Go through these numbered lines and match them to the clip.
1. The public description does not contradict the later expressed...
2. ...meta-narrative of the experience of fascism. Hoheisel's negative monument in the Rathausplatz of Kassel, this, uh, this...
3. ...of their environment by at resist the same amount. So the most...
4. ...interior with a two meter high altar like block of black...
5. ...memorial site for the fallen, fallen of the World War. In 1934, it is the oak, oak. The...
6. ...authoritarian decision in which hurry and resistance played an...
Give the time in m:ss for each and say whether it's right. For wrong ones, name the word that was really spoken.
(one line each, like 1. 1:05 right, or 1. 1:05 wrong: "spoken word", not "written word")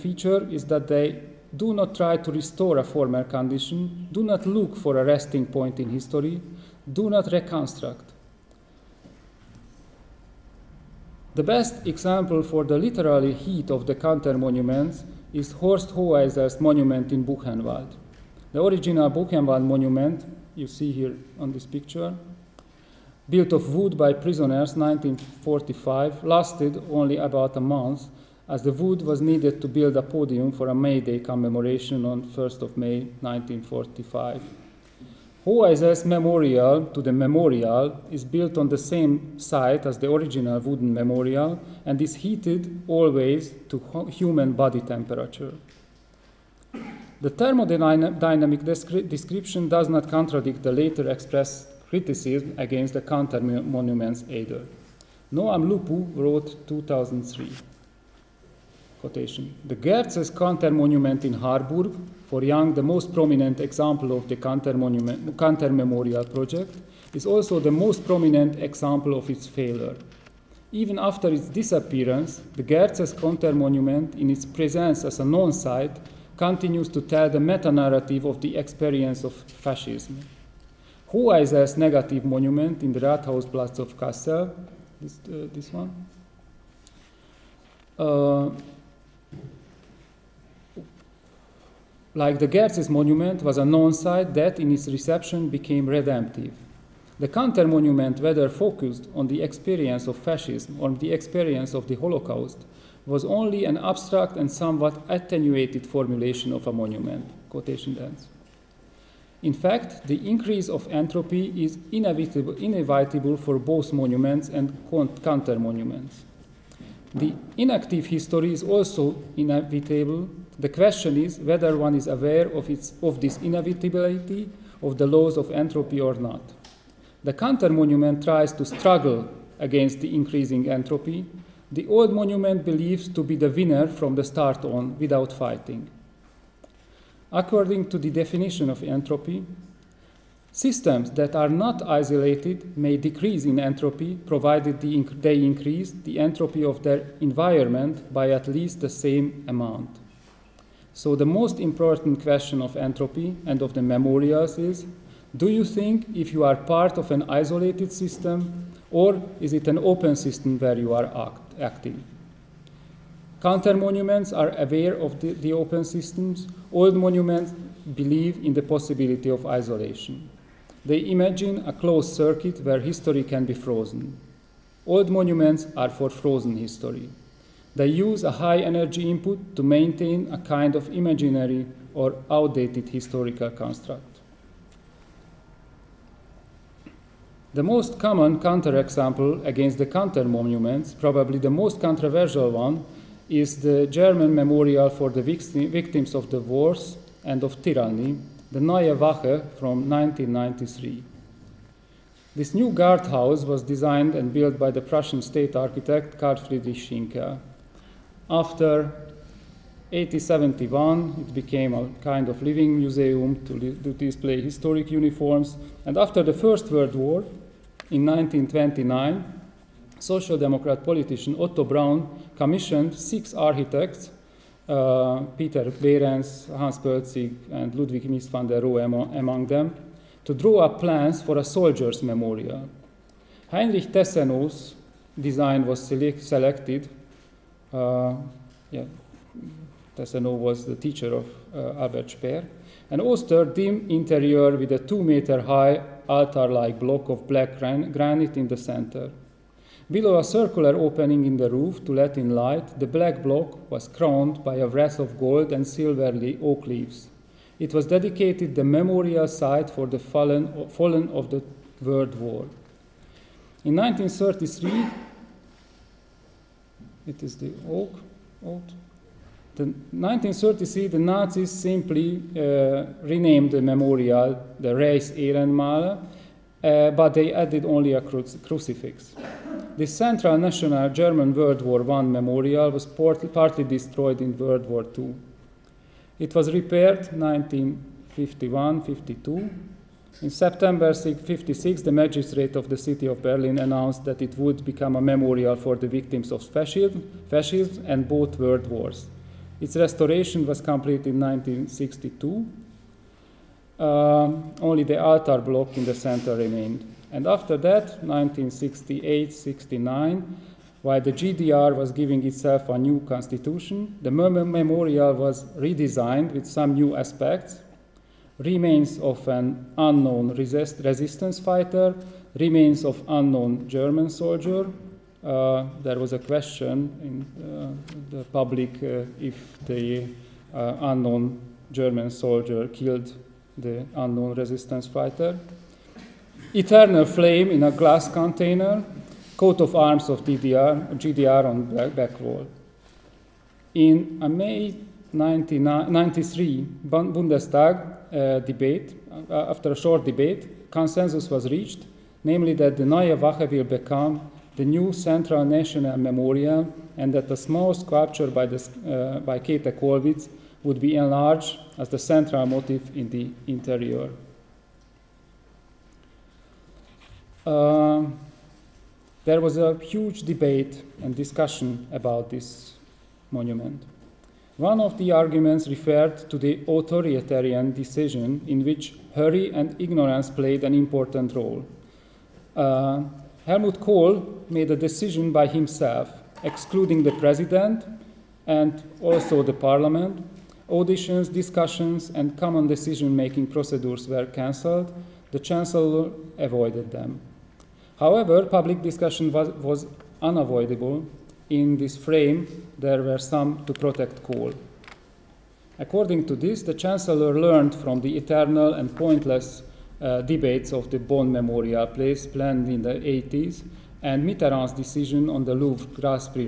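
1. 0:47 wrong: "thermodynamic", not "public"
2. 1:17 right
3. 2:26 wrong: "least", not "resist"
4. 4:03 right
5. 4:18 wrong: "1933", not "1934"
6. 6:16 wrong: "ignorance", not "resistance".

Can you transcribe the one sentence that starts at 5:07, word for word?
And after that, 1968-69, while the GDR was giving itself a new constitution, the memorial was redesigned with some new aspects.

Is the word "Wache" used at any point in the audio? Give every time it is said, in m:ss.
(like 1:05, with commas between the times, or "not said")
3:18, 5:53.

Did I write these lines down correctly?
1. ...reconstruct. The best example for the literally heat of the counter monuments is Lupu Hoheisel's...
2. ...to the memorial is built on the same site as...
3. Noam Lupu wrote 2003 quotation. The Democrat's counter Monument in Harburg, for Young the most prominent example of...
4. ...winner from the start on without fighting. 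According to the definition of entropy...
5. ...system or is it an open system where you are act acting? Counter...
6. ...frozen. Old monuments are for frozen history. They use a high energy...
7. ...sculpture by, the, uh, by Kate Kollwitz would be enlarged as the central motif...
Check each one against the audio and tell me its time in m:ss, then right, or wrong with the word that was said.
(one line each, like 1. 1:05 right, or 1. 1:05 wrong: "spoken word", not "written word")
1. 0:07 wrong: "Horst", not "Lupu"
2. 0:36 right
3. 0:55 wrong: "Gerz", not "Democrat"
4. 2:13 right
5. 2:37 right
6. 2:53 right
7. 5:57 right.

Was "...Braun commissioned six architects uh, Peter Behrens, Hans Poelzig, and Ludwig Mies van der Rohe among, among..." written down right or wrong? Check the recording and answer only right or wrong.
right.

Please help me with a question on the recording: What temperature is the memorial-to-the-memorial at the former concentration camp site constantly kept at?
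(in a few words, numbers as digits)
human body temperature.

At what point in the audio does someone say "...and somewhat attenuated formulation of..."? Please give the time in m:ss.
1:44.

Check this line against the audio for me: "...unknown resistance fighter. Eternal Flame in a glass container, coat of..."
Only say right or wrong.
right.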